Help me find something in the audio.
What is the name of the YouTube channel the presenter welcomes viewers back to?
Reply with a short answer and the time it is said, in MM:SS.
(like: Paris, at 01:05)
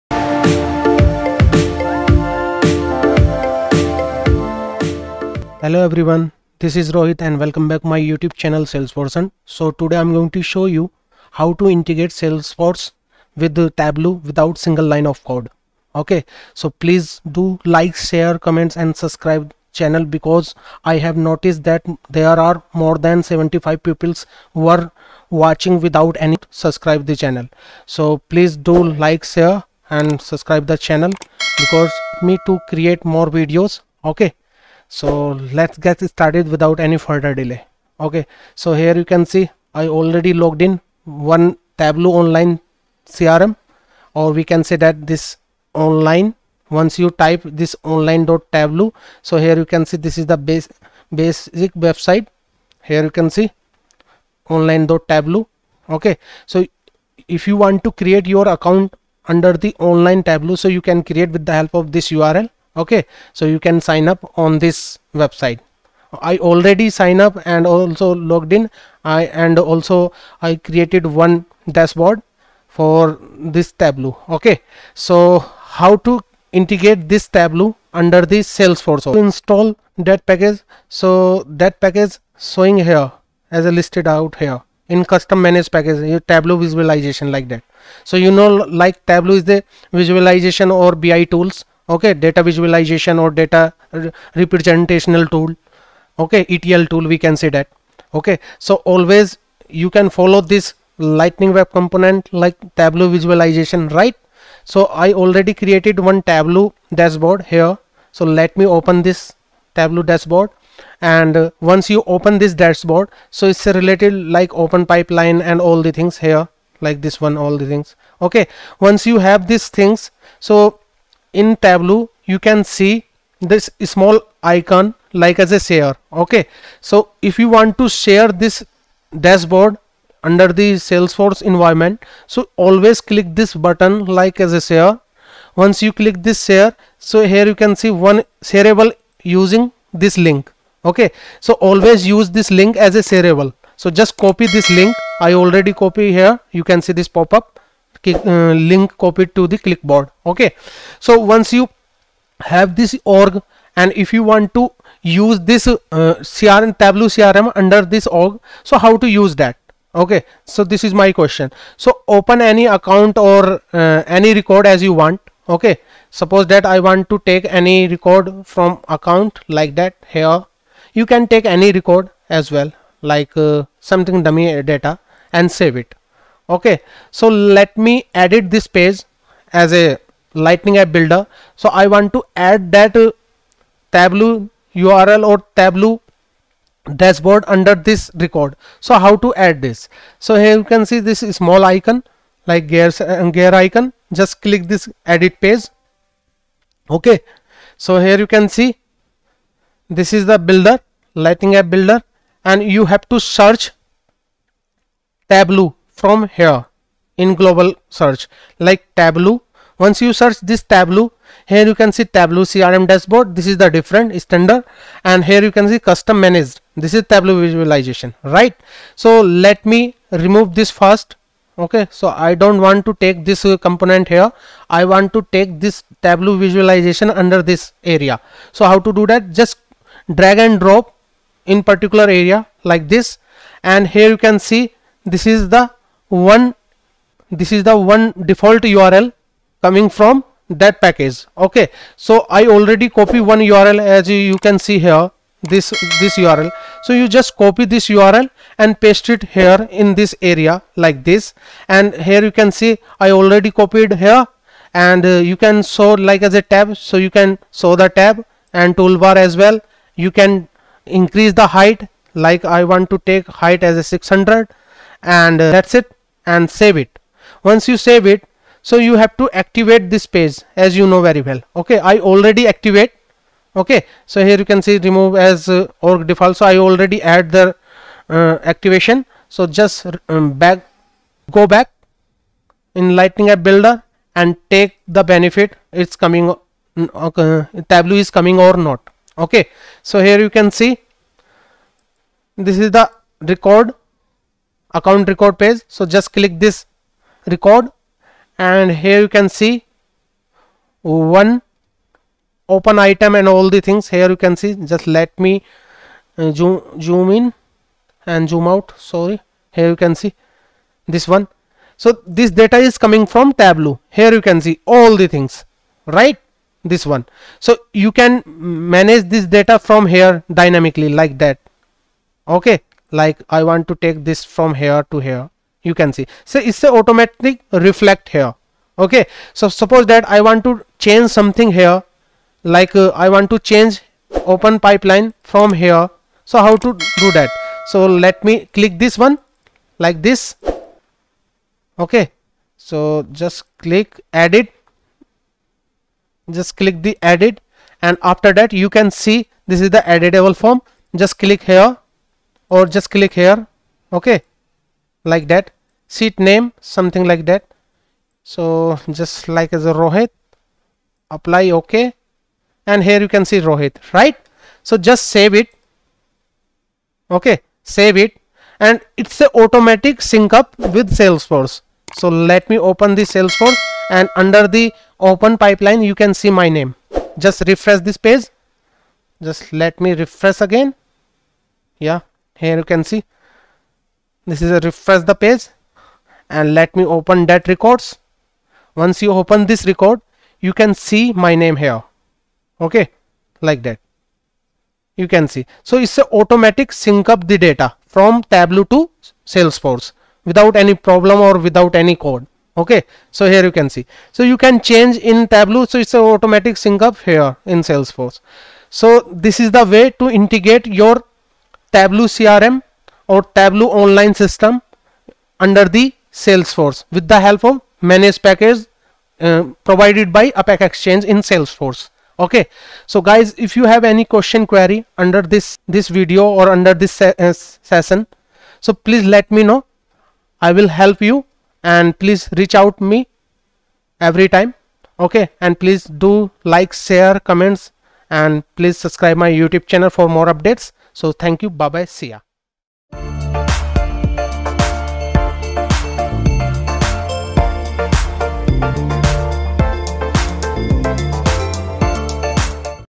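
Salesforce Hunt, at 00:08.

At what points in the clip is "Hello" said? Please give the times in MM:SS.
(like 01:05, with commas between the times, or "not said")
00:05.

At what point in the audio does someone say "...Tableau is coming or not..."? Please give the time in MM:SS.
04:47.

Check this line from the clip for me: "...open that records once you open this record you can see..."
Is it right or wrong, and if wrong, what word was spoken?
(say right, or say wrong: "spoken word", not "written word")
right.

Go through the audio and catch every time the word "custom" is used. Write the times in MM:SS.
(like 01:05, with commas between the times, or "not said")
01:25, 03:35.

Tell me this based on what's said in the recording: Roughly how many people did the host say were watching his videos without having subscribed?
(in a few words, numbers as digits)
75.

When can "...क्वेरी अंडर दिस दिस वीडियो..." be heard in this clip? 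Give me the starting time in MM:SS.
07:04.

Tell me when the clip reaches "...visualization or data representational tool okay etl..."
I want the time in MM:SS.
01:32.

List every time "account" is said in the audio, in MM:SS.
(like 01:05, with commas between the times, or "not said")
00:58, 02:42, 02:48, 04:54.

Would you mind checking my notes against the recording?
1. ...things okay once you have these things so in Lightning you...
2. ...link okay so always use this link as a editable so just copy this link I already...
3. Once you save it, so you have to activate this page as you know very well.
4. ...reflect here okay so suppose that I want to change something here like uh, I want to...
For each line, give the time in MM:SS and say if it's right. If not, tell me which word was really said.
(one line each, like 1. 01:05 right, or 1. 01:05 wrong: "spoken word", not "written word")
1. 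01:57 wrong: "Tableau", not "Lightning"
2. 02:20 wrong: "shareable", not "editable"
3. 04:27 right
4. 05:27 right.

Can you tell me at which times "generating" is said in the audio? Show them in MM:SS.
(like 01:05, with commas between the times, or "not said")
not said.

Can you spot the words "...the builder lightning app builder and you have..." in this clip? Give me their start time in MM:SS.
03:20.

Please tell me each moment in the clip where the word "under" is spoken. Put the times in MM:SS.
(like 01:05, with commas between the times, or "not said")
00:59, 01:17, 02:10, 02:37, 03:07, 03:47, 06:14.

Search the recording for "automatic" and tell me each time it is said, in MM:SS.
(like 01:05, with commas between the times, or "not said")
05:26, 06:09, 06:36, 06:46.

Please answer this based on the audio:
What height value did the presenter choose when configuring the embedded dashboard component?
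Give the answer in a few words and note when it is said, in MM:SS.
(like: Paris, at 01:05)
600, at 04:23.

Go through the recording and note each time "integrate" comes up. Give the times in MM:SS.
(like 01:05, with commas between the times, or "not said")
00:11, 01:16, 06:50.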